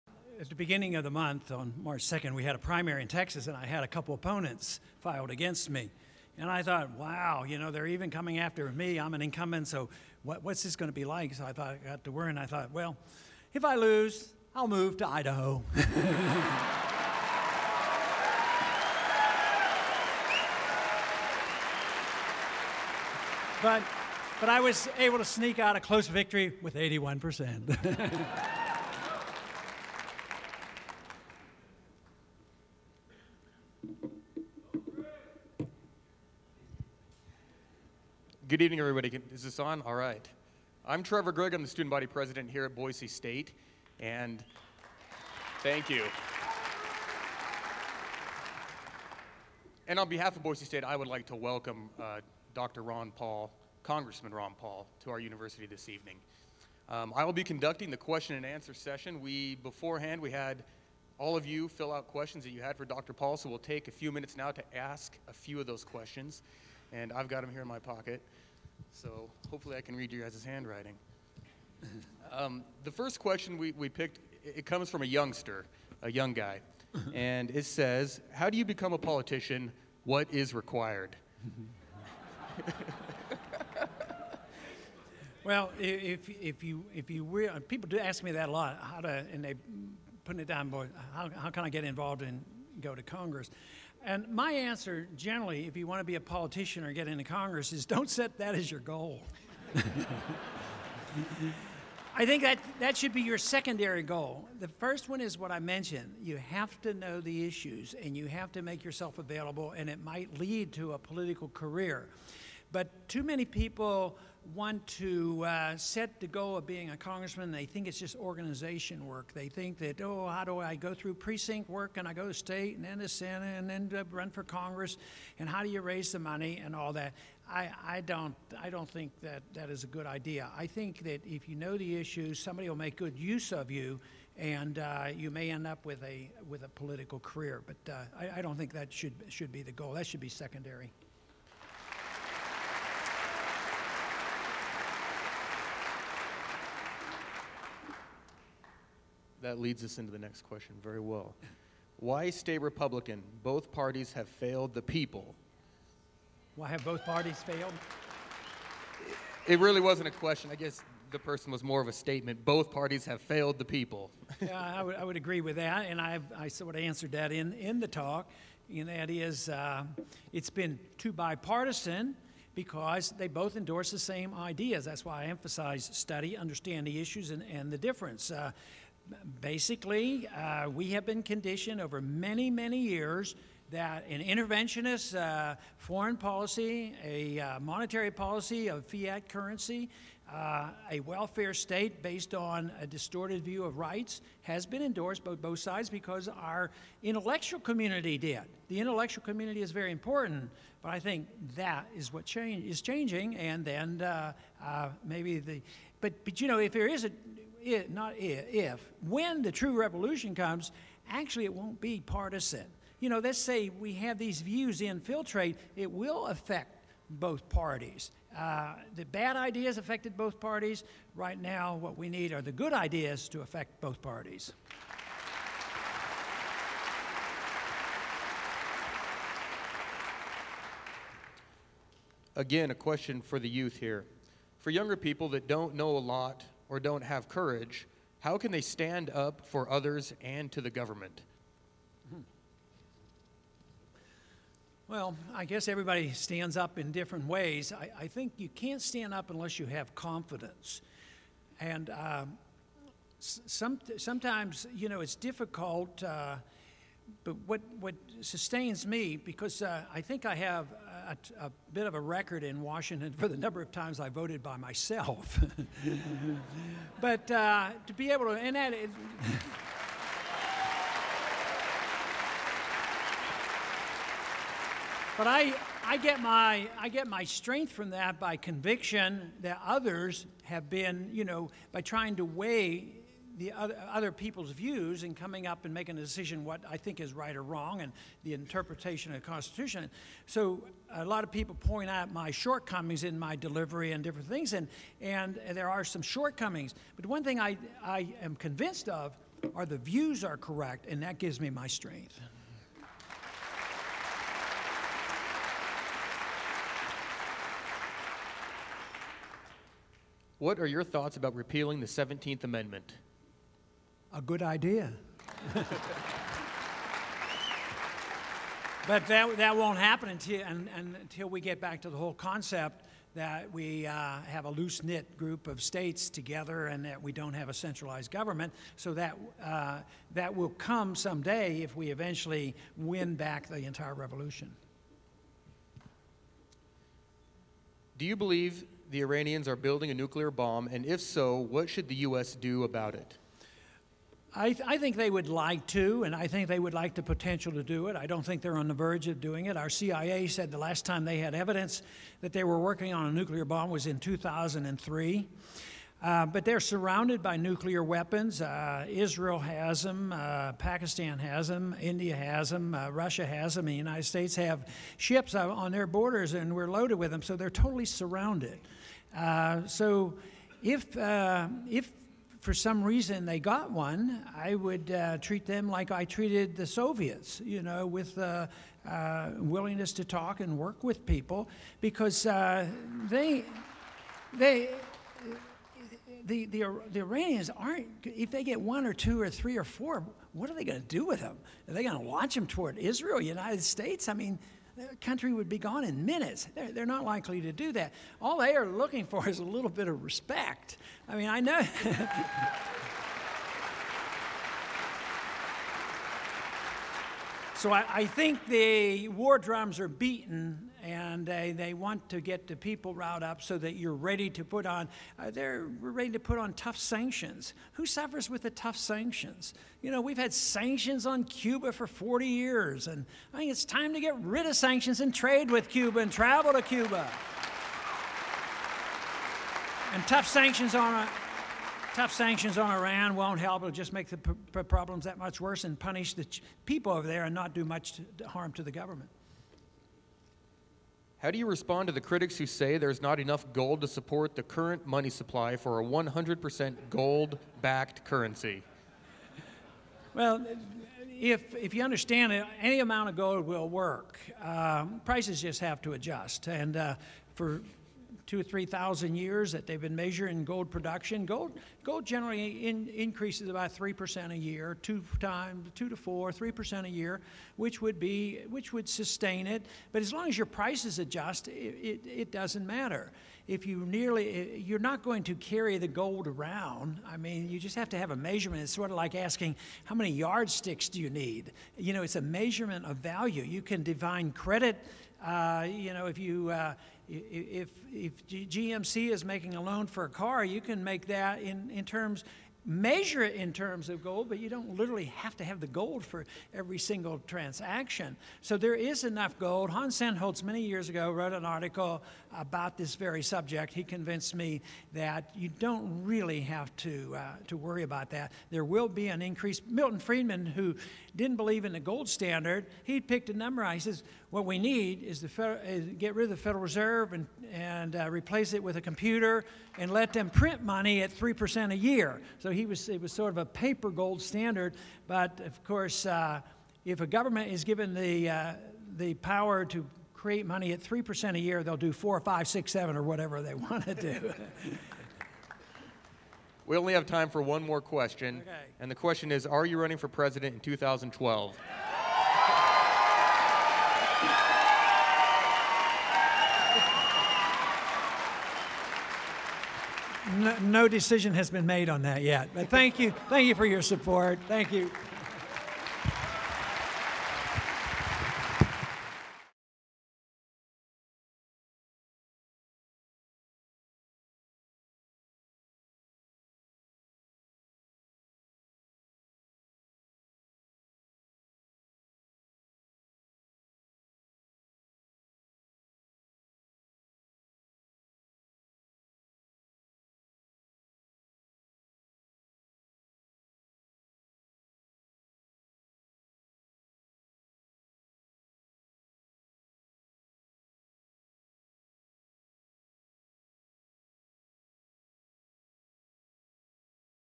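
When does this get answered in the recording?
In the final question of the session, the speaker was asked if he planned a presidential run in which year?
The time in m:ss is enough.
9:00.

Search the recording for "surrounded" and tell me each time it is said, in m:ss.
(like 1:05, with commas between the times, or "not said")
5:56, 6:07.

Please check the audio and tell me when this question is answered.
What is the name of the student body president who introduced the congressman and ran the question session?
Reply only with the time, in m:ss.
0:41.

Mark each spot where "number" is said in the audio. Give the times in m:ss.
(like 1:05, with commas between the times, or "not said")
4:23, 8:33.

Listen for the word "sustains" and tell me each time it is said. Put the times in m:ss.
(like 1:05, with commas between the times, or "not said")
4:18, 7:48.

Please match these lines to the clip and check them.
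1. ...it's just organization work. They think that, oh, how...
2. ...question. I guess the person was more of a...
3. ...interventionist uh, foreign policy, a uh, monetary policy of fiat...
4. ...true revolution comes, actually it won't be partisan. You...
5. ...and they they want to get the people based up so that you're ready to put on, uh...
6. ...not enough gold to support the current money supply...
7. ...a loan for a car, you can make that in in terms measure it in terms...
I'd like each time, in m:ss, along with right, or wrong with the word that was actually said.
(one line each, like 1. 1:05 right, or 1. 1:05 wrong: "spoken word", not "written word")
1. 1:57 right
2. 2:40 right
3. 3:04 right
4. 3:29 right
5. 6:50 wrong: "riled", not "based"
6. 7:22 right
7. 8:09 right.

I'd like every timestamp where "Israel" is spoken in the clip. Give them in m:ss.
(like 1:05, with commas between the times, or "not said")
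5:58, 6:32.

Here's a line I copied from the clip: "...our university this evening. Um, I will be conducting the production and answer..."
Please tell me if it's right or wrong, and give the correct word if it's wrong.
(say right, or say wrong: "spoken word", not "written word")
wrong: "question", not "production".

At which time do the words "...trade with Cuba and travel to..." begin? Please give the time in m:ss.
7:05.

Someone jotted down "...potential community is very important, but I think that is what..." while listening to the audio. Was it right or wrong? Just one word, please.
wrong.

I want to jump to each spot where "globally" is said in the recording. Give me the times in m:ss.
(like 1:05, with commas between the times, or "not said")
not said.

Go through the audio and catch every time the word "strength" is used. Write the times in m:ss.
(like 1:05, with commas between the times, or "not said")
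4:37, 5:01.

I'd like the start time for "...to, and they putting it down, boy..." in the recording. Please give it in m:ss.
1:28.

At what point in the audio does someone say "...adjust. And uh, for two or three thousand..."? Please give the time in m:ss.
7:35.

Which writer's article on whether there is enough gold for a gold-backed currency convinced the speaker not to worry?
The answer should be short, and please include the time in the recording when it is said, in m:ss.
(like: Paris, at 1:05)
Hans Sennholz, at 8:19.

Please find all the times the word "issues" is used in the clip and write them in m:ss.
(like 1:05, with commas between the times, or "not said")
1:47, 2:11, 2:57.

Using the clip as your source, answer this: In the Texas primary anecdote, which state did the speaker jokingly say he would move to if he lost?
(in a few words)
Idaho.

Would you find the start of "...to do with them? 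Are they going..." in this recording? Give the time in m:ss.
6:30.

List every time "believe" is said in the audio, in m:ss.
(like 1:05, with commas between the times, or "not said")
5:38, 8:31.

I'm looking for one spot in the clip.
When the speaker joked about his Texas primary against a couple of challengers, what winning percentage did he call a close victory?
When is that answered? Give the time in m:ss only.
0:26.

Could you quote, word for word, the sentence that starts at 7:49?
But as long as your prices adjust, it, it, it doesn't matter.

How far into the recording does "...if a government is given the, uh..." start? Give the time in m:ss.
8:46.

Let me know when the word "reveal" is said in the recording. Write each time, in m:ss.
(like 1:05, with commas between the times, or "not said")
not said.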